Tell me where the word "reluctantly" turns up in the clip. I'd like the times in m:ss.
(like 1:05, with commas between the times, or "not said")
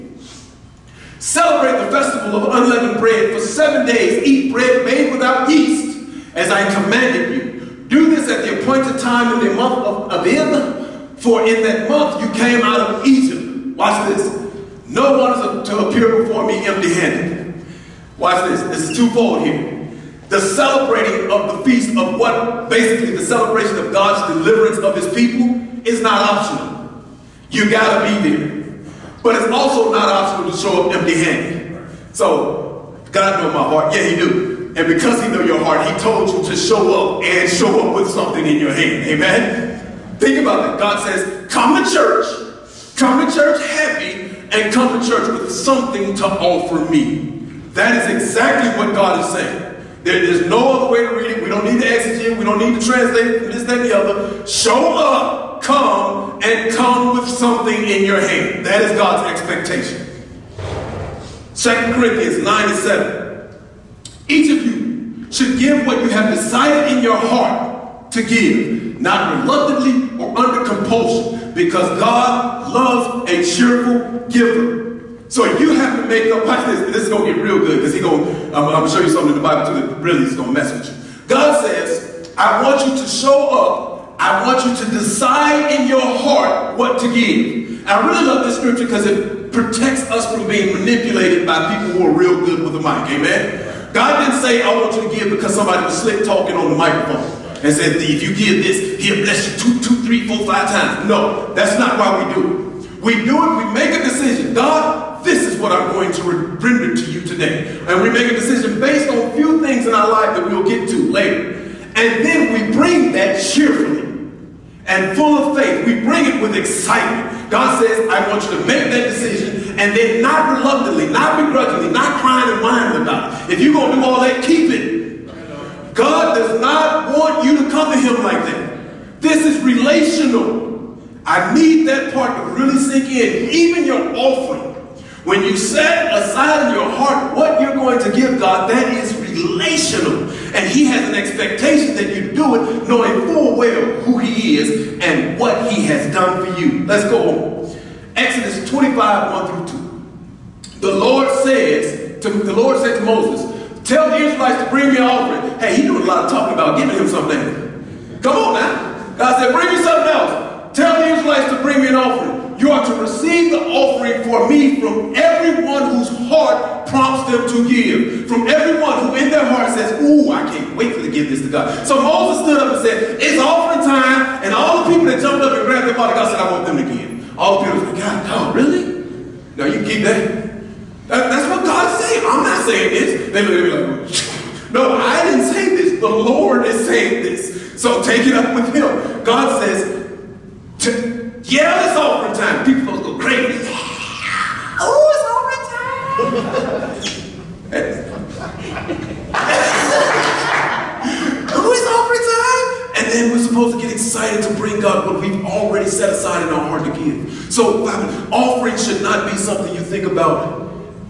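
1:09, 2:00.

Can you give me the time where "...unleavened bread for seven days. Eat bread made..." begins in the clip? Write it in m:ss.
0:02.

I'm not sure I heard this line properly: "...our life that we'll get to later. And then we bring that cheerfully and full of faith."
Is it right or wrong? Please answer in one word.
right.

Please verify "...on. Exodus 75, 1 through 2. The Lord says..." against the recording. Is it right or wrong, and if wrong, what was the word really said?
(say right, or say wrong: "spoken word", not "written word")
wrong: "25", not "75".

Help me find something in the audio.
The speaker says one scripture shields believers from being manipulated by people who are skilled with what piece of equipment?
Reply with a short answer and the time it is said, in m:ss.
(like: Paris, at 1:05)
the microphone, at 1:32.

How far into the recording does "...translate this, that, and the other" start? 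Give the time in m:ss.
0:52.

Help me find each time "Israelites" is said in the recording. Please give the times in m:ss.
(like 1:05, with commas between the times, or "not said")
2:34, 2:41.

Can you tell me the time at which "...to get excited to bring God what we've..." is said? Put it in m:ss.
3:23.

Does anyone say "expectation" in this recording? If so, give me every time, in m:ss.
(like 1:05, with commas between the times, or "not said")
0:59, 2:21.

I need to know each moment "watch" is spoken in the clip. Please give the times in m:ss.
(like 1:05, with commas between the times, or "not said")
0:13, 0:18, 1:16.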